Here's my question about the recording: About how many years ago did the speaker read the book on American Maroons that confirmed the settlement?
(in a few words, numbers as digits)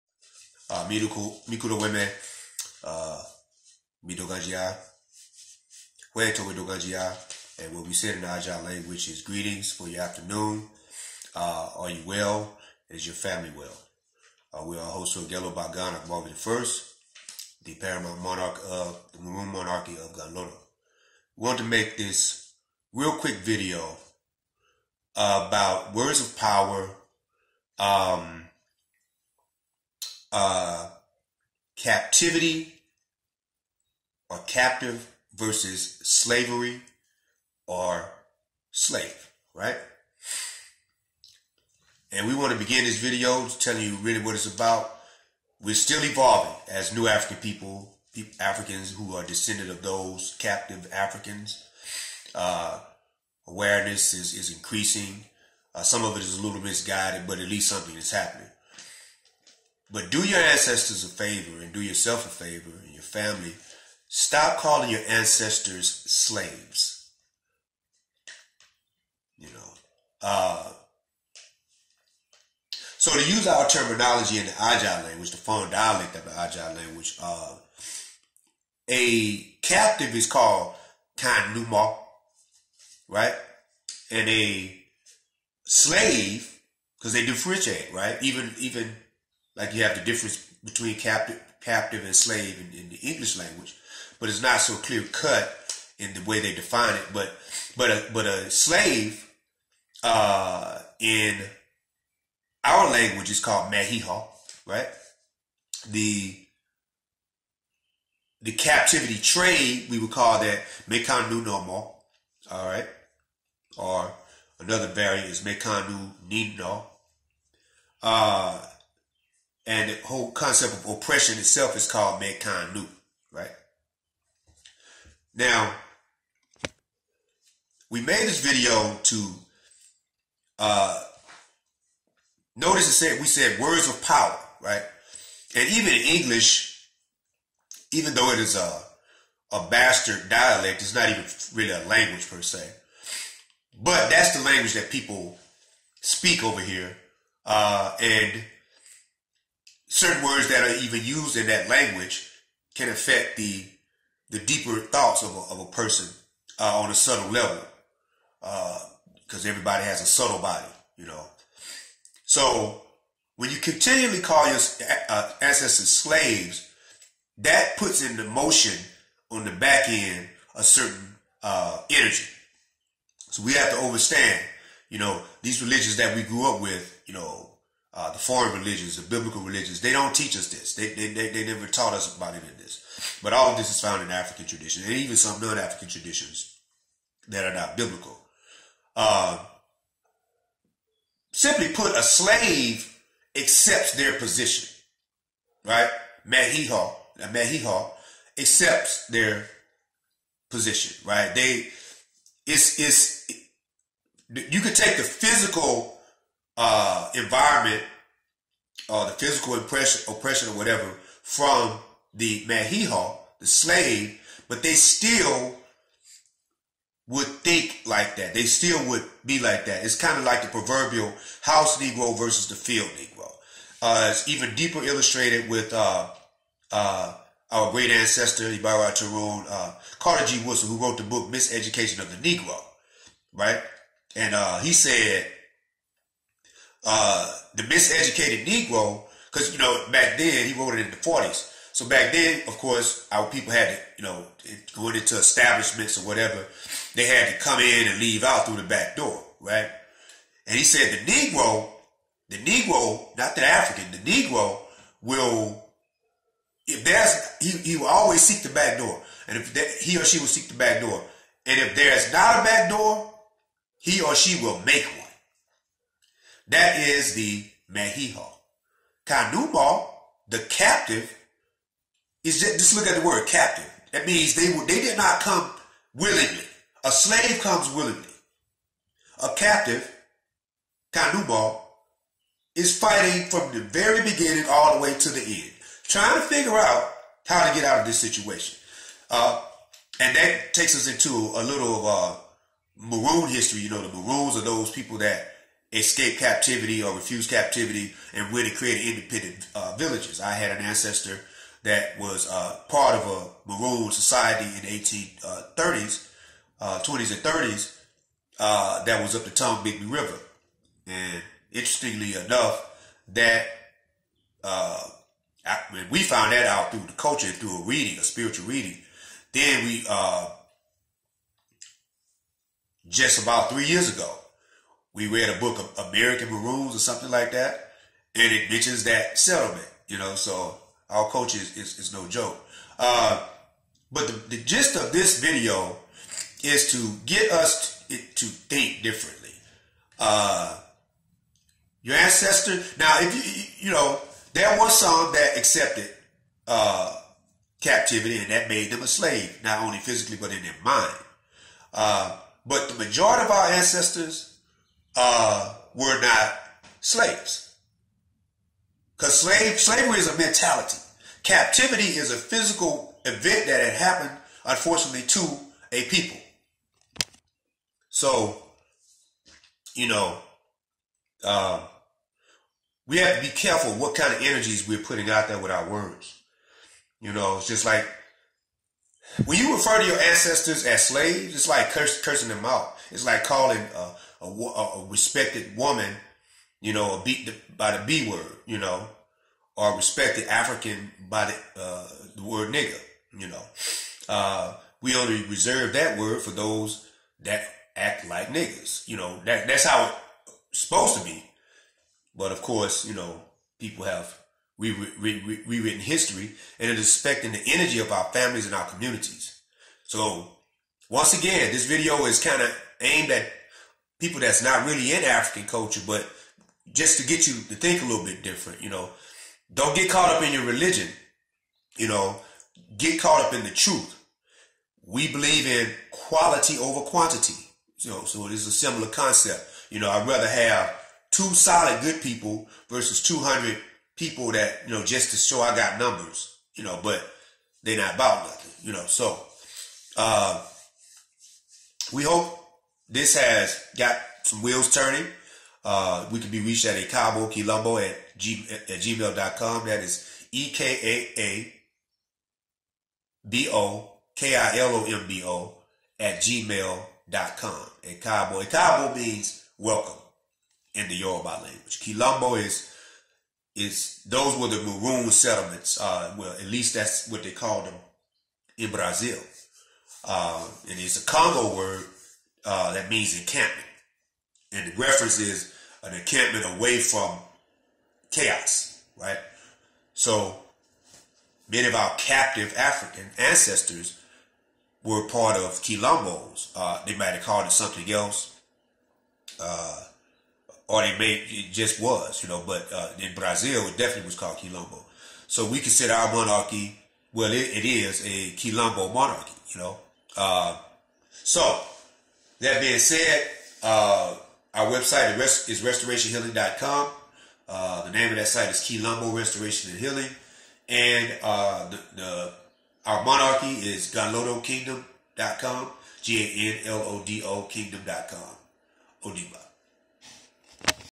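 3.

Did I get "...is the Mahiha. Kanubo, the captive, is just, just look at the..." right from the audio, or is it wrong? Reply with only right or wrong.
right.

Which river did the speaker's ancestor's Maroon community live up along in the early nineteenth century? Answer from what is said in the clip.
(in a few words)
Tombigbee River.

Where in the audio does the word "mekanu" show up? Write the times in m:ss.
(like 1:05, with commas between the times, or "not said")
1:50, 1:55.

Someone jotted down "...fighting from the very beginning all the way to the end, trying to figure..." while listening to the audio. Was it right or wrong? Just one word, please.
right.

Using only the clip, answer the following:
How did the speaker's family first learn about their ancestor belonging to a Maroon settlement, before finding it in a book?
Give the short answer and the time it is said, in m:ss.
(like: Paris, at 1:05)
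a spiritual reading, at 5:17.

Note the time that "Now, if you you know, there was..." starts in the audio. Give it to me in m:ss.
5:42.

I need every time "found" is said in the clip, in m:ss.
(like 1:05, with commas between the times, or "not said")
3:03, 5:15.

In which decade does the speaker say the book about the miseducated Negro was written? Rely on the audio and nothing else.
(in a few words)
forties.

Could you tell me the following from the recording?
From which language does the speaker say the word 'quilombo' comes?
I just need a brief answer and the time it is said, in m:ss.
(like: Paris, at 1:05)
Congo, at 7:51.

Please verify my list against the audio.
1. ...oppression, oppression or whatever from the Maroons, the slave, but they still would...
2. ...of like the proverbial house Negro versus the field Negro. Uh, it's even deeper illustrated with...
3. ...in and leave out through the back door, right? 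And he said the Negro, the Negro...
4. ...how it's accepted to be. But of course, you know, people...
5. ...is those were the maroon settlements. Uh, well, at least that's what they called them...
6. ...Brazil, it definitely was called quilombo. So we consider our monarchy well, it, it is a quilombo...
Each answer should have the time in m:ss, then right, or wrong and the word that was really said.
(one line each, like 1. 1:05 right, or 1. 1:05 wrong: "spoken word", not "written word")
1. 3:29 wrong: "Mahiha", not "Maroons"
2. 3:40 right
3. 4:07 right
4. 6:39 wrong: "supposed", not "accepted"
5. 7:43 right
6. 8:13 right.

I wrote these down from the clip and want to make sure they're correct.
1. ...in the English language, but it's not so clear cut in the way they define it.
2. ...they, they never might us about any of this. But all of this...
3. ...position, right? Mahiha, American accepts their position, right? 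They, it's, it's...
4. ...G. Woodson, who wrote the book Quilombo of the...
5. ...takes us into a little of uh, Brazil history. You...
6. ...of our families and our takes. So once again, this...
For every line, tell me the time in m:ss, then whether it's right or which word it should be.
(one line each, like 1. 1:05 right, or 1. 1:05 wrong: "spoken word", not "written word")
1. 1:32 right
2. 3:01 wrong: "taught", not "might"
3. 3:14 wrong: "Mahiha", not "American"
4. 3:50 wrong: "Miseducation", not "Quilombo"
5. 4:50 wrong: "Maroon", not "Brazil"
6. 6:47 wrong: "communities", not "takes".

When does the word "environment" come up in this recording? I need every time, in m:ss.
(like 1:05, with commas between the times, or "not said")
3:27.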